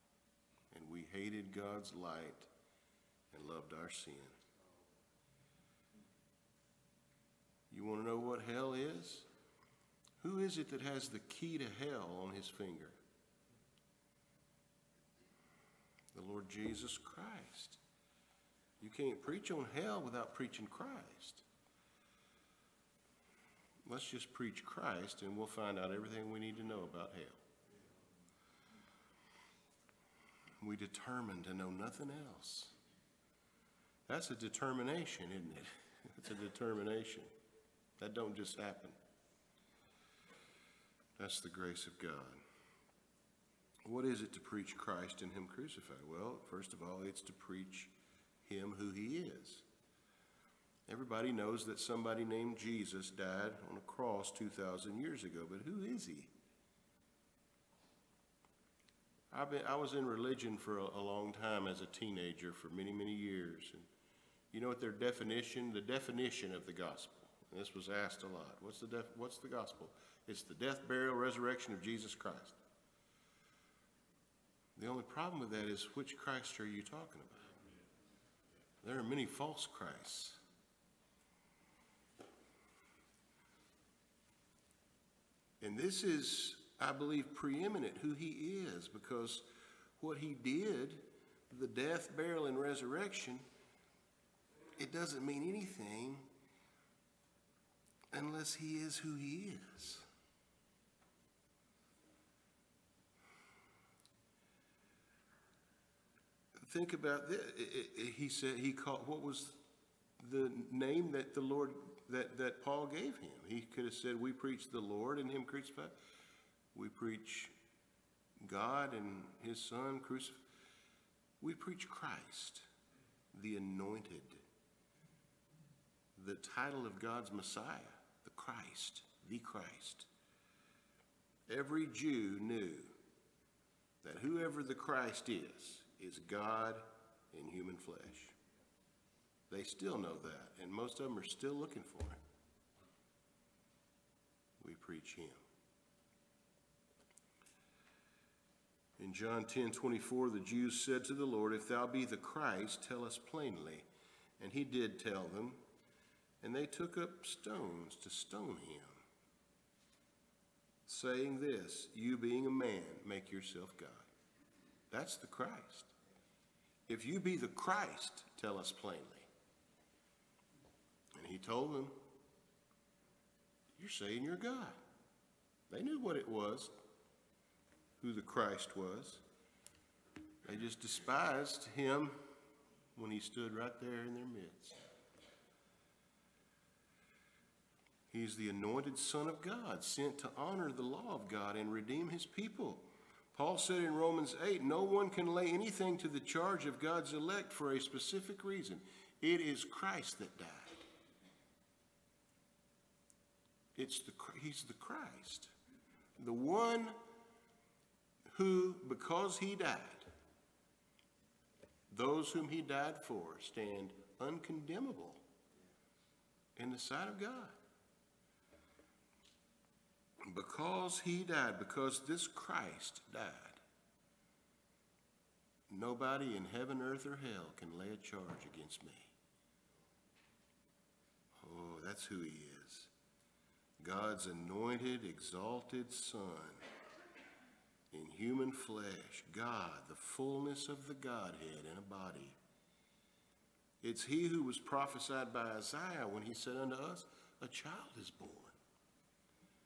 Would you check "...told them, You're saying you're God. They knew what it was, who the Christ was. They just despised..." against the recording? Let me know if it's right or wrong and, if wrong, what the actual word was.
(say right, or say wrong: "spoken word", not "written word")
right.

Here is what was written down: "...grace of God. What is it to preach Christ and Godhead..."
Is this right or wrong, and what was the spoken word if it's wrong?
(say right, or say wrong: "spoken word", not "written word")
wrong: "Him", not "Godhead".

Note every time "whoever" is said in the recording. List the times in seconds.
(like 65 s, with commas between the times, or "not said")
134 s.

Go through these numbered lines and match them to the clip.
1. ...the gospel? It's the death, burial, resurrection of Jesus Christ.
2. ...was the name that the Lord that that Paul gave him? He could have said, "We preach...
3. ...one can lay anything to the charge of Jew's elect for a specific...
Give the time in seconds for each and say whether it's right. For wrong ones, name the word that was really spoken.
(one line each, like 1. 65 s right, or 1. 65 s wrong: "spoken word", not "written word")
1. 69 s right
2. 109 s right
3. 194 s wrong: "God", not "Jew".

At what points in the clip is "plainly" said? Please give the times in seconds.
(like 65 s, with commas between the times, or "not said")
153 s, 168 s.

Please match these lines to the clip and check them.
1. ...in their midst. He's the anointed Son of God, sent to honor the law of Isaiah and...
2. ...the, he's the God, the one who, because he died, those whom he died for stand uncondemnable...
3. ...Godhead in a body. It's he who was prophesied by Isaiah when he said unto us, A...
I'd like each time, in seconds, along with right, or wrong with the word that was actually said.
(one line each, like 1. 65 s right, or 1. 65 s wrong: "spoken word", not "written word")
1. 184 s wrong: "God", not "Isaiah"
2. 204 s wrong: "Christ", not "God"
3. 240 s right.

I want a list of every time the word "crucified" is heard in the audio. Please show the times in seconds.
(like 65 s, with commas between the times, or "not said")
45 s, 115 s, 119 s.